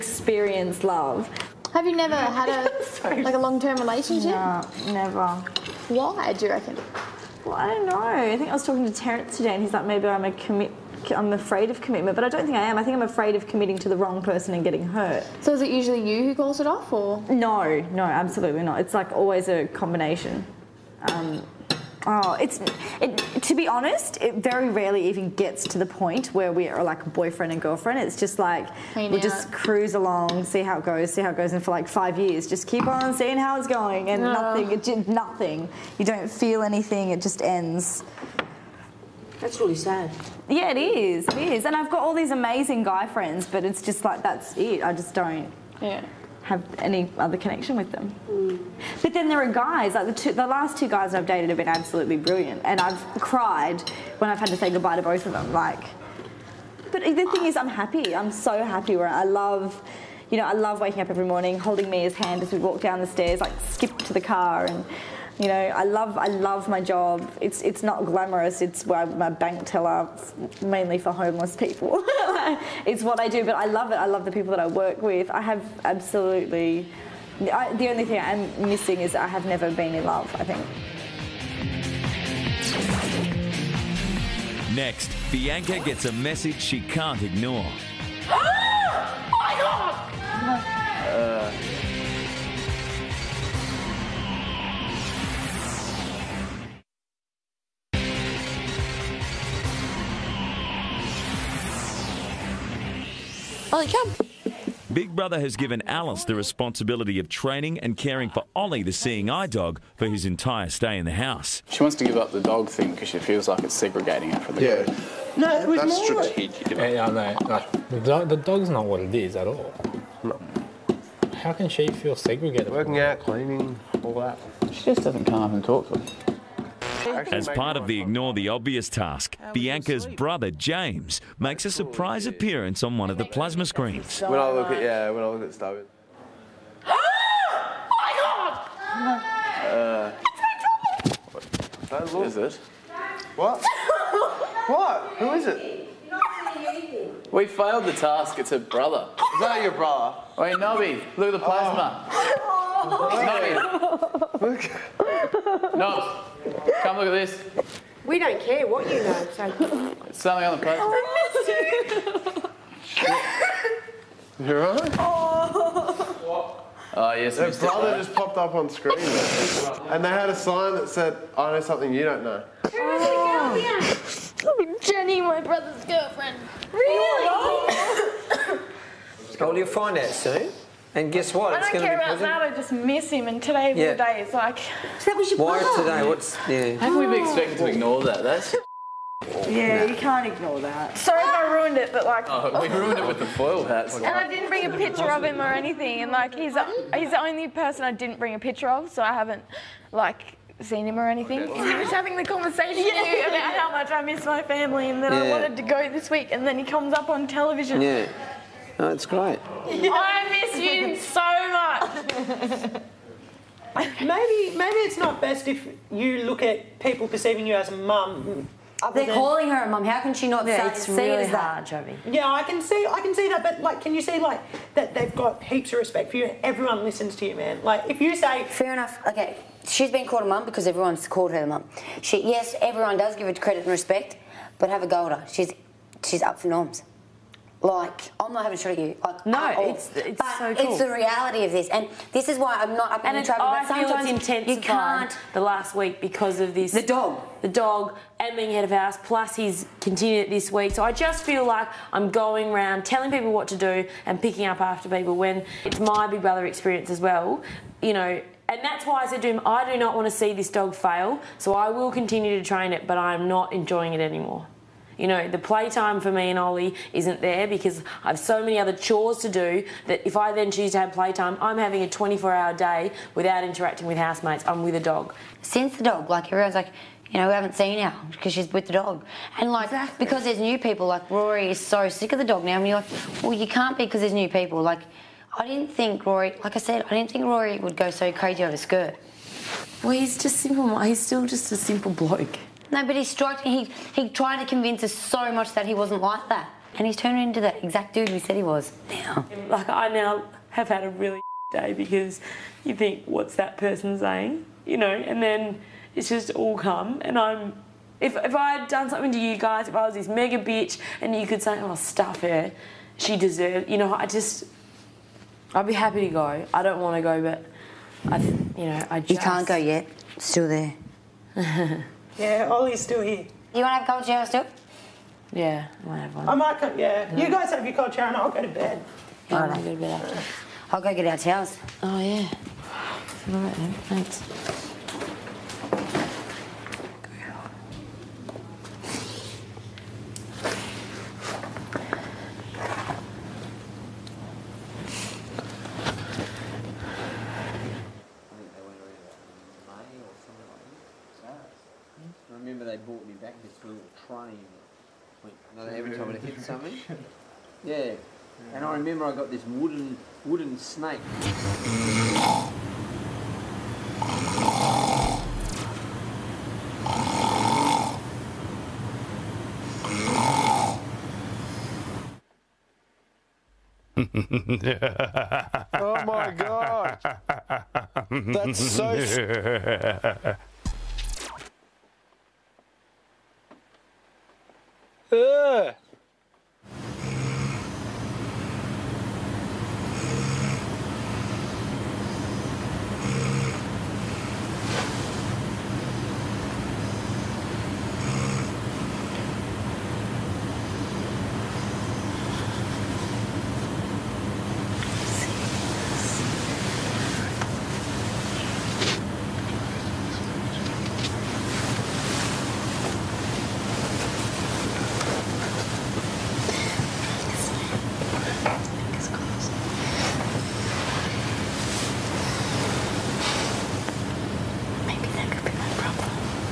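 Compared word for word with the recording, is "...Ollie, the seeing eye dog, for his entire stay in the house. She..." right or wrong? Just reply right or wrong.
right.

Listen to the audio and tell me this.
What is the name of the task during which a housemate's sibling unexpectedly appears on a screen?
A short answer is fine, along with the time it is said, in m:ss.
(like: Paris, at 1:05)
Ignore the Obvious, at 2:08.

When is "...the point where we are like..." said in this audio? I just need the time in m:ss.
0:25.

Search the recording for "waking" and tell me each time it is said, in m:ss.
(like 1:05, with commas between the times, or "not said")
1:00.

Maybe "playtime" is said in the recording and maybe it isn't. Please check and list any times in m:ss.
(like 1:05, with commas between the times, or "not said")
4:25, 4:30.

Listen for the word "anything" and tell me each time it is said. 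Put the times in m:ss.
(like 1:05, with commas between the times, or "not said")
0:36, 3:15, 3:21.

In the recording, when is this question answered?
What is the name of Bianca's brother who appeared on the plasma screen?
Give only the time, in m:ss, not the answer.
2:10.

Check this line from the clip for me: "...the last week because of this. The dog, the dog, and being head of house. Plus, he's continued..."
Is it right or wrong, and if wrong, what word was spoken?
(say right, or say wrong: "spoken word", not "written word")
right.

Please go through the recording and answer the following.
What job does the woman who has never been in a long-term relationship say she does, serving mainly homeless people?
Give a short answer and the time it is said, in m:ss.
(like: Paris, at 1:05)
Bank teller, at 1:09.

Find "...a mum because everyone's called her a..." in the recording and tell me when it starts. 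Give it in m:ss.
3:50.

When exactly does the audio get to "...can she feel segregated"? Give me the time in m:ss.
2:01.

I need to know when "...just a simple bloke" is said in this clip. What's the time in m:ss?
4:51.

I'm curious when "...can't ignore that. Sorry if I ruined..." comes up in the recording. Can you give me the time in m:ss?
3:09.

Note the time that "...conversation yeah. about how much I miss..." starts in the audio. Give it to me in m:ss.
3:22.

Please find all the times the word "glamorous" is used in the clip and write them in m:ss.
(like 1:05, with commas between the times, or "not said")
1:08.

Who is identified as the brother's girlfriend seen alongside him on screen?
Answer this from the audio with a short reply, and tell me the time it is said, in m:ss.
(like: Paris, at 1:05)
Jenny, at 2:54.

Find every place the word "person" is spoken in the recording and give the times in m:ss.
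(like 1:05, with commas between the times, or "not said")
0:14, 3:17, 5:03.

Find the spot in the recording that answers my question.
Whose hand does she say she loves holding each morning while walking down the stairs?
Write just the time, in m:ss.
1:01.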